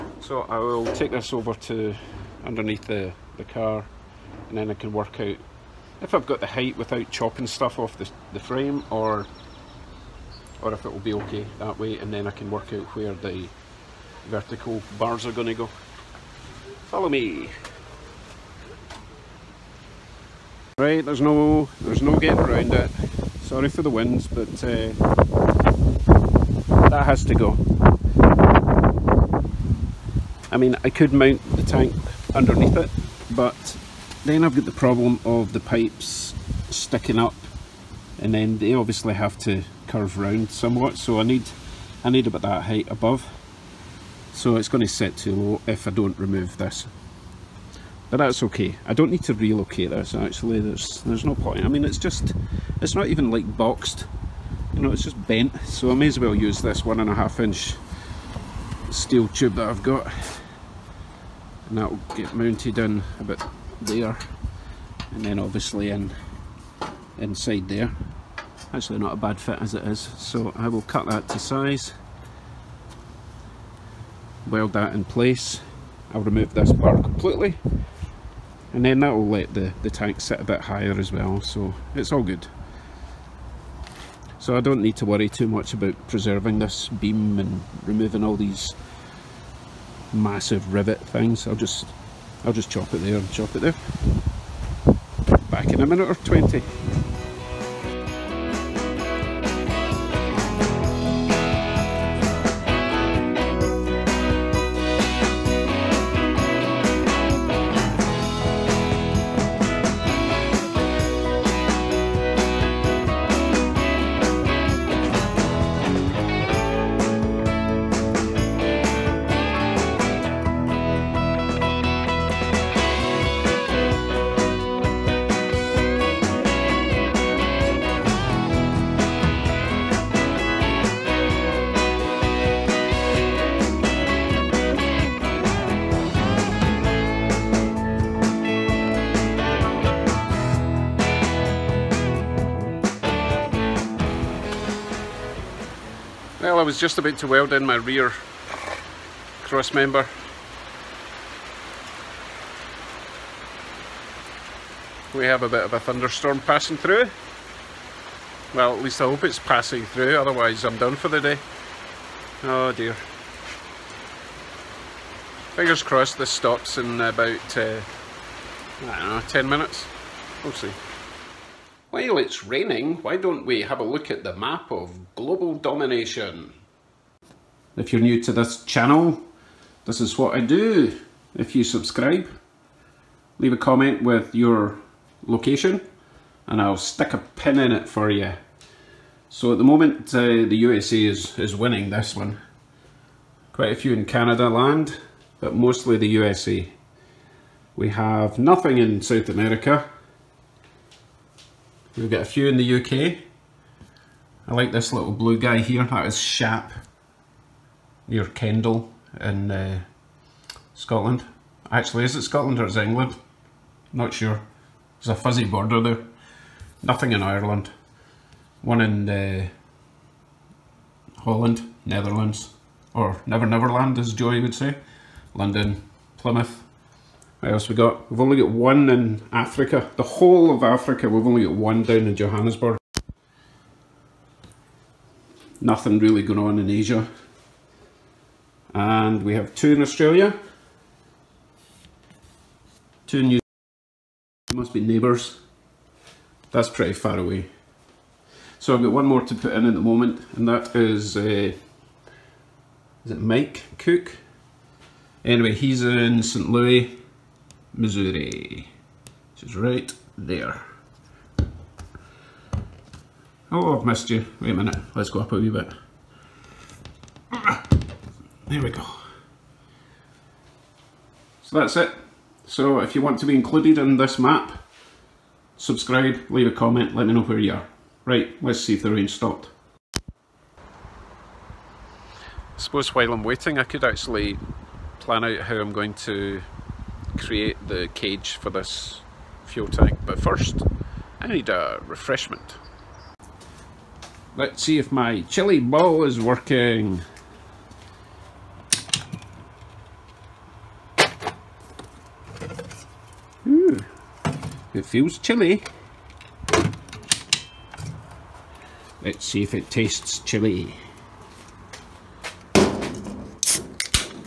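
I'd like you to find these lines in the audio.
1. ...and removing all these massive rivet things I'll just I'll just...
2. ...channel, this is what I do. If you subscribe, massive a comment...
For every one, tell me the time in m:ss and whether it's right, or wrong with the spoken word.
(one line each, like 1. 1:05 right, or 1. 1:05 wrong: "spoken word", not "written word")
1. 1:27 right
2. 2:58 wrong: "leave", not "massive".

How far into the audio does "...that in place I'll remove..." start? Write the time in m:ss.
1:14.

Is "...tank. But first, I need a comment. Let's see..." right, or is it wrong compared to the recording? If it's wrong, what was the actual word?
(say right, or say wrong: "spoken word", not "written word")
wrong: "refreshment", not "comment".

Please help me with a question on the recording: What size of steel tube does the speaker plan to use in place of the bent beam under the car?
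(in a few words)
1.5 inch.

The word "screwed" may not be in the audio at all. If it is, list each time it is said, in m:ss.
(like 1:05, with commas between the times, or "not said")
not said.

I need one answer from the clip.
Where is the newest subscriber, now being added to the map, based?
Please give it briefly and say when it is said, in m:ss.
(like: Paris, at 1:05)
St. Louis, Missouri, at 4:16.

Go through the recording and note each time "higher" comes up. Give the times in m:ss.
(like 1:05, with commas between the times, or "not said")
1:20.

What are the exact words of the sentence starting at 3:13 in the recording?
Quite a few in Canada land, but mostly the USA.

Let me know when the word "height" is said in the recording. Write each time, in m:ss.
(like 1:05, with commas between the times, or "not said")
0:06, 0:42.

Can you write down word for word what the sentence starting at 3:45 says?
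London, Plymouth, what else we got?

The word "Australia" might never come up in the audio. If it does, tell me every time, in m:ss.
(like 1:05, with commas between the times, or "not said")
3:59.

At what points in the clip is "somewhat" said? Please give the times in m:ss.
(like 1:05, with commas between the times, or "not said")
0:40.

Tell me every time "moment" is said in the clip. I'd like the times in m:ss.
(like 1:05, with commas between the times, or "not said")
3:09, 4:09.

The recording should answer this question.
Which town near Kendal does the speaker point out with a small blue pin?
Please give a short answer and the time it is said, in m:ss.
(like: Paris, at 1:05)
Shap, at 3:26.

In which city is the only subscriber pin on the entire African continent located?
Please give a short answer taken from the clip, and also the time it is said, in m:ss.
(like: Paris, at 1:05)
Johannesburg, at 3:52.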